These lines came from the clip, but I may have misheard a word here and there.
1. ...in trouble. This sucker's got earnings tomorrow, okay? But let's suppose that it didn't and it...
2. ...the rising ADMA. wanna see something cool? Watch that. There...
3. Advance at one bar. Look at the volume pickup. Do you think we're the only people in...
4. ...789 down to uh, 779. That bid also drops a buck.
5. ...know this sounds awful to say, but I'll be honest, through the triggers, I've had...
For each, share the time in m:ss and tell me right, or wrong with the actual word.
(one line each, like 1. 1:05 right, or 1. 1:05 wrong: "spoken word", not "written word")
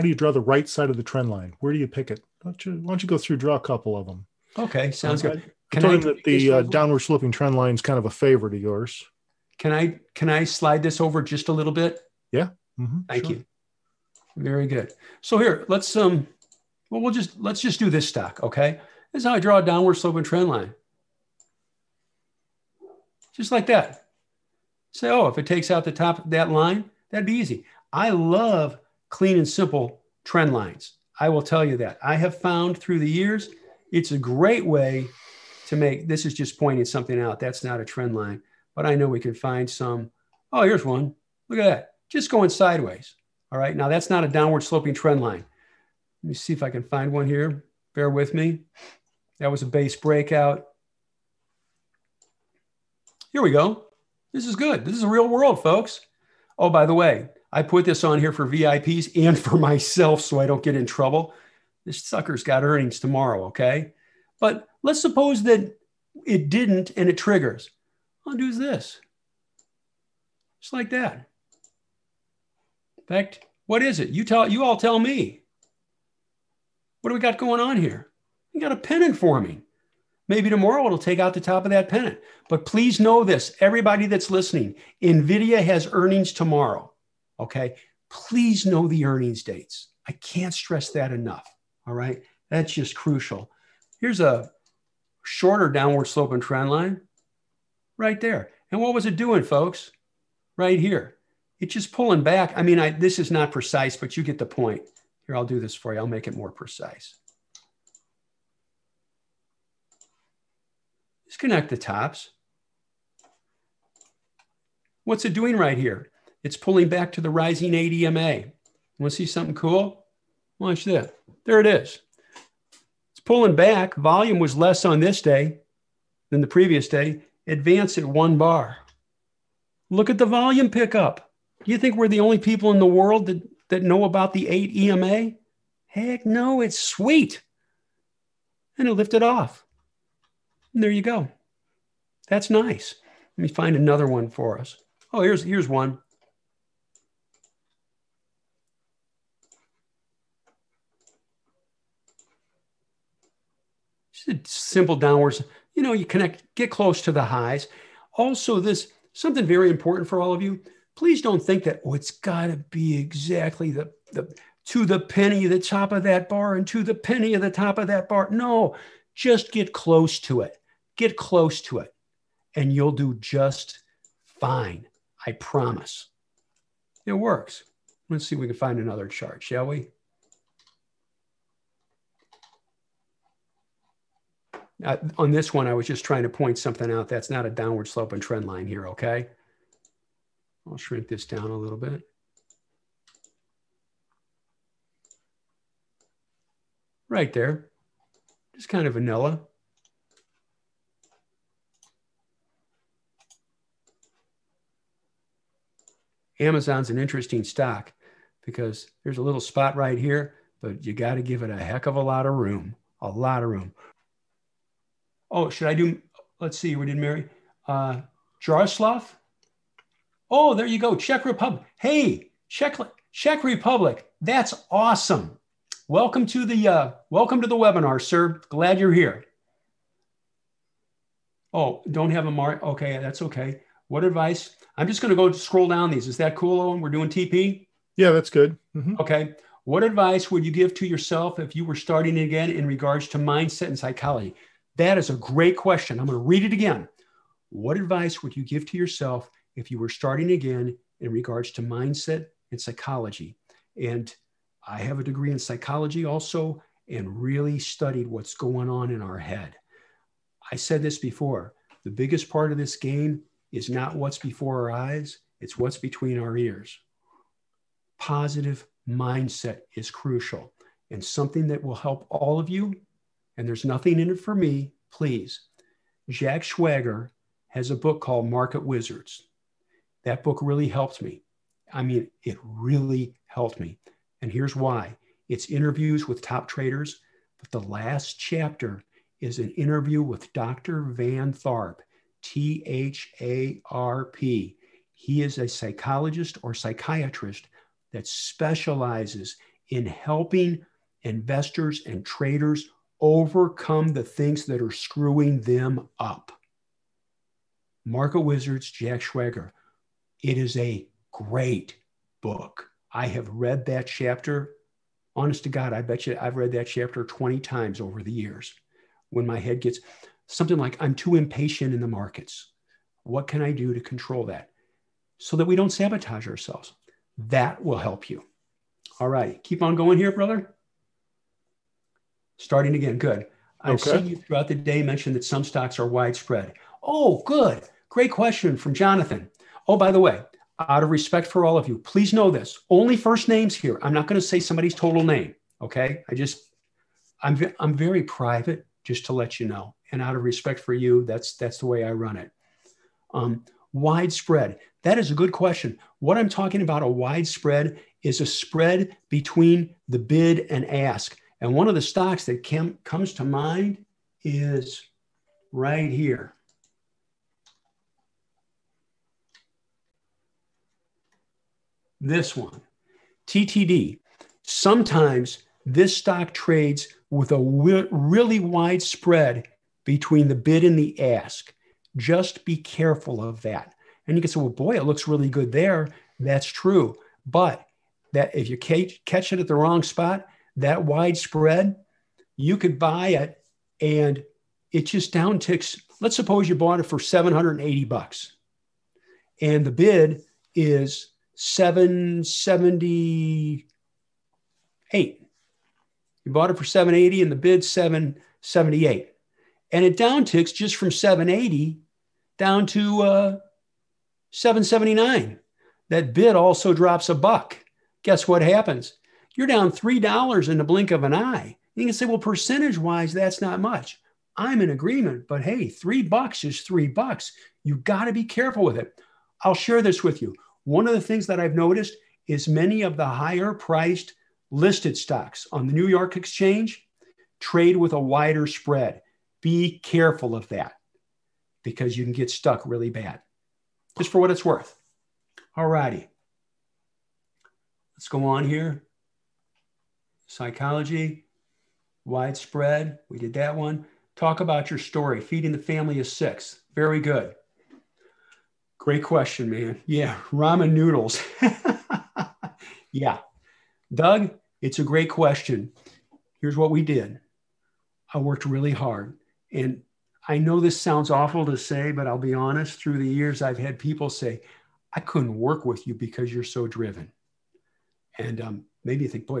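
1. 1:00 right
2. 1:57 right
3. 2:07 right
4. 6:50 wrong: "780", not "789"
5. 7:50 wrong: "years", not "triggers".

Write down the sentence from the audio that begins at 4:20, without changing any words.
I said this before the biggest part of this game is not what's before our eyes, it's what's between our ears.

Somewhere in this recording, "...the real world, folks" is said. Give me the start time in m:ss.
0:55.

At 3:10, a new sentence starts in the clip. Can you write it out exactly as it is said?
I'll shrink this down a little bit.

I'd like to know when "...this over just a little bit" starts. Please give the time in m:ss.
0:10.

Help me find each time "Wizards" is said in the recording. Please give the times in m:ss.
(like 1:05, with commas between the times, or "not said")
4:38, 5:08.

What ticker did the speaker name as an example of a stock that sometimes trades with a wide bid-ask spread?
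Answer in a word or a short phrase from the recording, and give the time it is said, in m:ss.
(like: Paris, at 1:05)
TTD, at 6:13.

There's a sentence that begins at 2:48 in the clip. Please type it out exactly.
No, just get close to it get close to it and you'll do just fine.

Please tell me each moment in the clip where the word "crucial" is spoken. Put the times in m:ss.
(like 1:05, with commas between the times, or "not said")
1:32, 4:29.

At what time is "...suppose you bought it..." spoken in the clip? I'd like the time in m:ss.
6:36.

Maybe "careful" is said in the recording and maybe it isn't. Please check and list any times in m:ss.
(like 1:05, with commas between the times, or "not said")
6:22, 7:08, 7:19.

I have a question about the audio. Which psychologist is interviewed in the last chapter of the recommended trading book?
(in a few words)
Van Tharp.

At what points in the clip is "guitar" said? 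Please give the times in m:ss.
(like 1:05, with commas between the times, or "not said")
not said.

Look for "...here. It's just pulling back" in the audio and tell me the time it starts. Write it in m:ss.
1:40.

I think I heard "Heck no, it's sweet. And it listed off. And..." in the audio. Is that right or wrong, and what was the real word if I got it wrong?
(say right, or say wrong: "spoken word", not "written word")
wrong: "lifted", not "listed".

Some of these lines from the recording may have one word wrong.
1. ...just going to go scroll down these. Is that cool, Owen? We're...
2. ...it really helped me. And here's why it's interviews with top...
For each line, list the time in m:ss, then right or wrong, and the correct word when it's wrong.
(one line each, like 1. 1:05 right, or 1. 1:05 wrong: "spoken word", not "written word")
1. 3:54 right
2. 4:42 right.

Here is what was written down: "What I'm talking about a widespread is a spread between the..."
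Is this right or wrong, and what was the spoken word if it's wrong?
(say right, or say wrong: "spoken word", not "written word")
right.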